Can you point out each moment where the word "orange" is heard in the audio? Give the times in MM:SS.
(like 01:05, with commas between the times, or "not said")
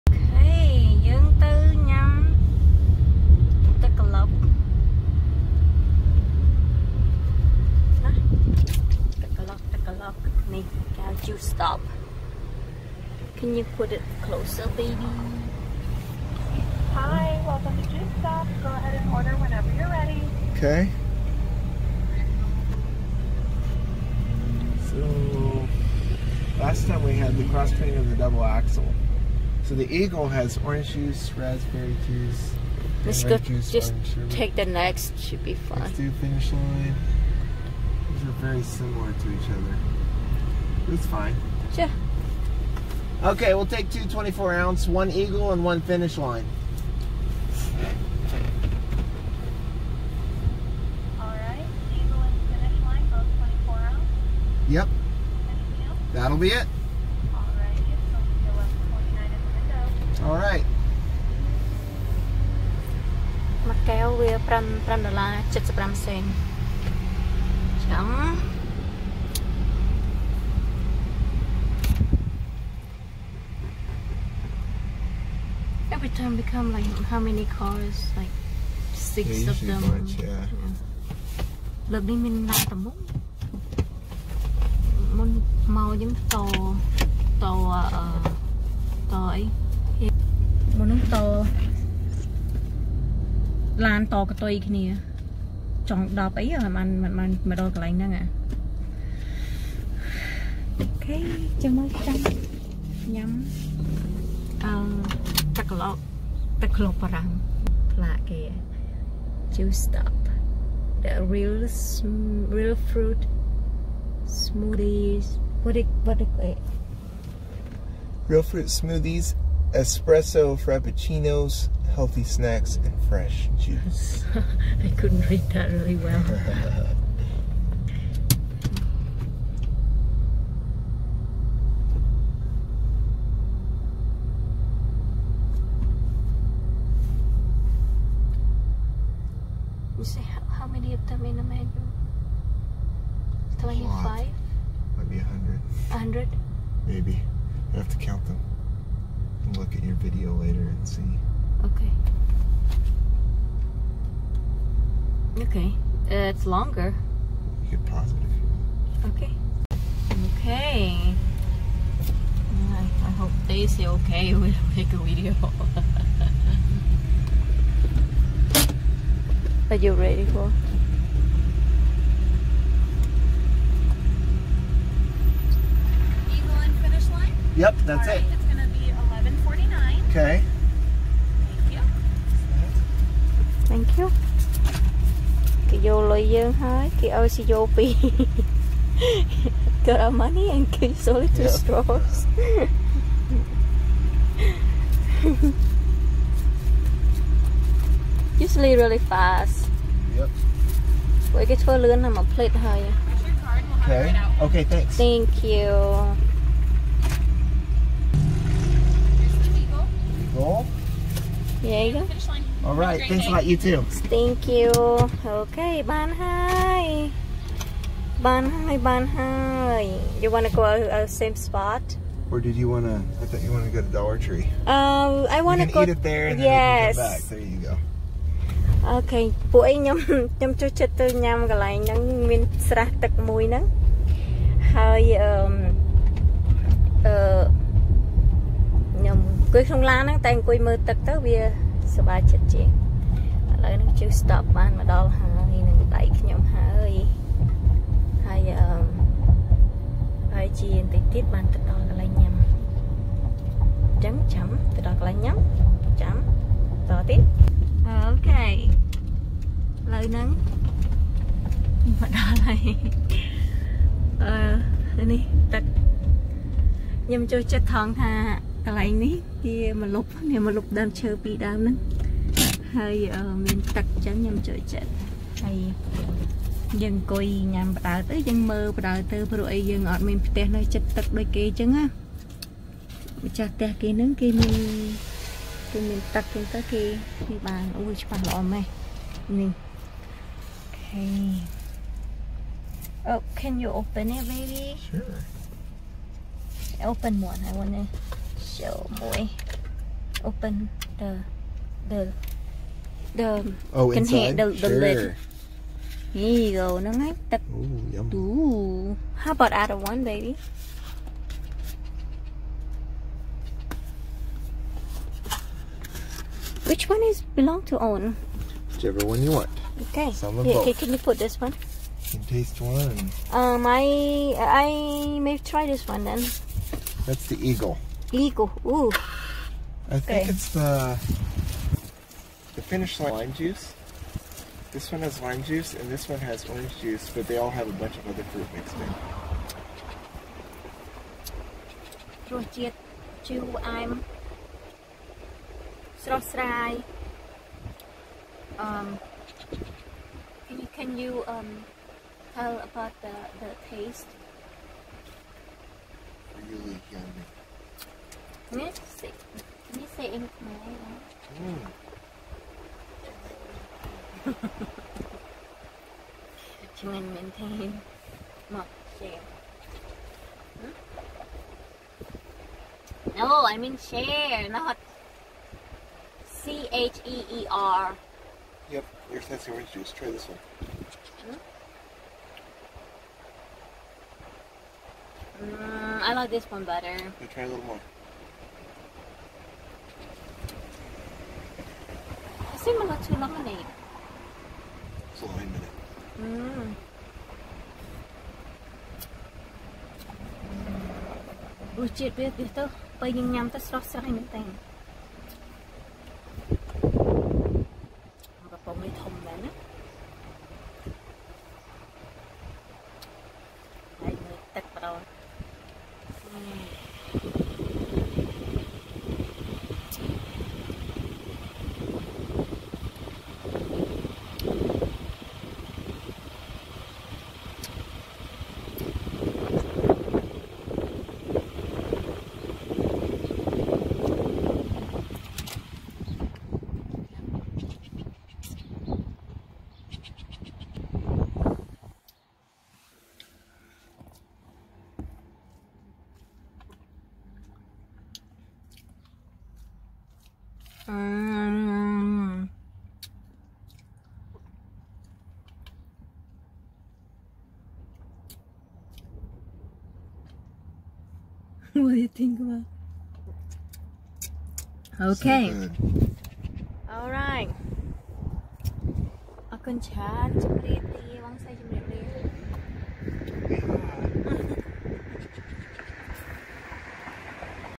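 00:30, 05:36, 06:19.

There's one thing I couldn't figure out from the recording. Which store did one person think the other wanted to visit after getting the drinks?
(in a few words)
Dollar Tree.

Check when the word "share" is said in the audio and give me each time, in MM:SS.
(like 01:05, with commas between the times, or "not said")
06:08, 06:13.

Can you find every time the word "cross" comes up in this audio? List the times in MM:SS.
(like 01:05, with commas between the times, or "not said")
00:27.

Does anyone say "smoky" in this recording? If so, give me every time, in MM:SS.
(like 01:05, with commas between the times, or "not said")
not said.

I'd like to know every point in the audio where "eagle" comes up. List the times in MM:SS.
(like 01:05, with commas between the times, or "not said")
00:29, 00:45, 00:51, 05:27.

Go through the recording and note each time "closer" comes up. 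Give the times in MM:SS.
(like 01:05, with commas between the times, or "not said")
00:14.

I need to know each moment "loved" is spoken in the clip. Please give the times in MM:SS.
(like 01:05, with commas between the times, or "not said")
not said.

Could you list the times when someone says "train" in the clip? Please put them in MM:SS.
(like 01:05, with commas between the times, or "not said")
00:27.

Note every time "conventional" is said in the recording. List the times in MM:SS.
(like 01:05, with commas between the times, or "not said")
not said.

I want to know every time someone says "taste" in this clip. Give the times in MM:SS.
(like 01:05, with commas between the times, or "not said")
05:22, 05:53.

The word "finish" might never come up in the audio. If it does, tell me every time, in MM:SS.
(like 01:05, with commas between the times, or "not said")
00:36, 00:45, 00:52.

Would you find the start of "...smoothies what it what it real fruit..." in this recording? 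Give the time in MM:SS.
01:54.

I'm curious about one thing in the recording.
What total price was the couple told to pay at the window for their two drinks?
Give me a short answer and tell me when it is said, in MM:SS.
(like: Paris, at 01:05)
$11.49, at 02:59.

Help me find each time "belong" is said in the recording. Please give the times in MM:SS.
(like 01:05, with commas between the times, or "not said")
05:17.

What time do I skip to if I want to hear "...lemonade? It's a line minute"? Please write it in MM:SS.
06:33.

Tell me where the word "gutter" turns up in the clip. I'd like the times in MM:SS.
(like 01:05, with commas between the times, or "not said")
not said.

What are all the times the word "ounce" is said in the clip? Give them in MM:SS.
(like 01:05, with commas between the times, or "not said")
00:44, 00:53.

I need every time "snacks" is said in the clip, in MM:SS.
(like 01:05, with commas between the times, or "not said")
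02:02.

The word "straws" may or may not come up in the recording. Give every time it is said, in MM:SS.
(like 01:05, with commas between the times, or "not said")
03:11.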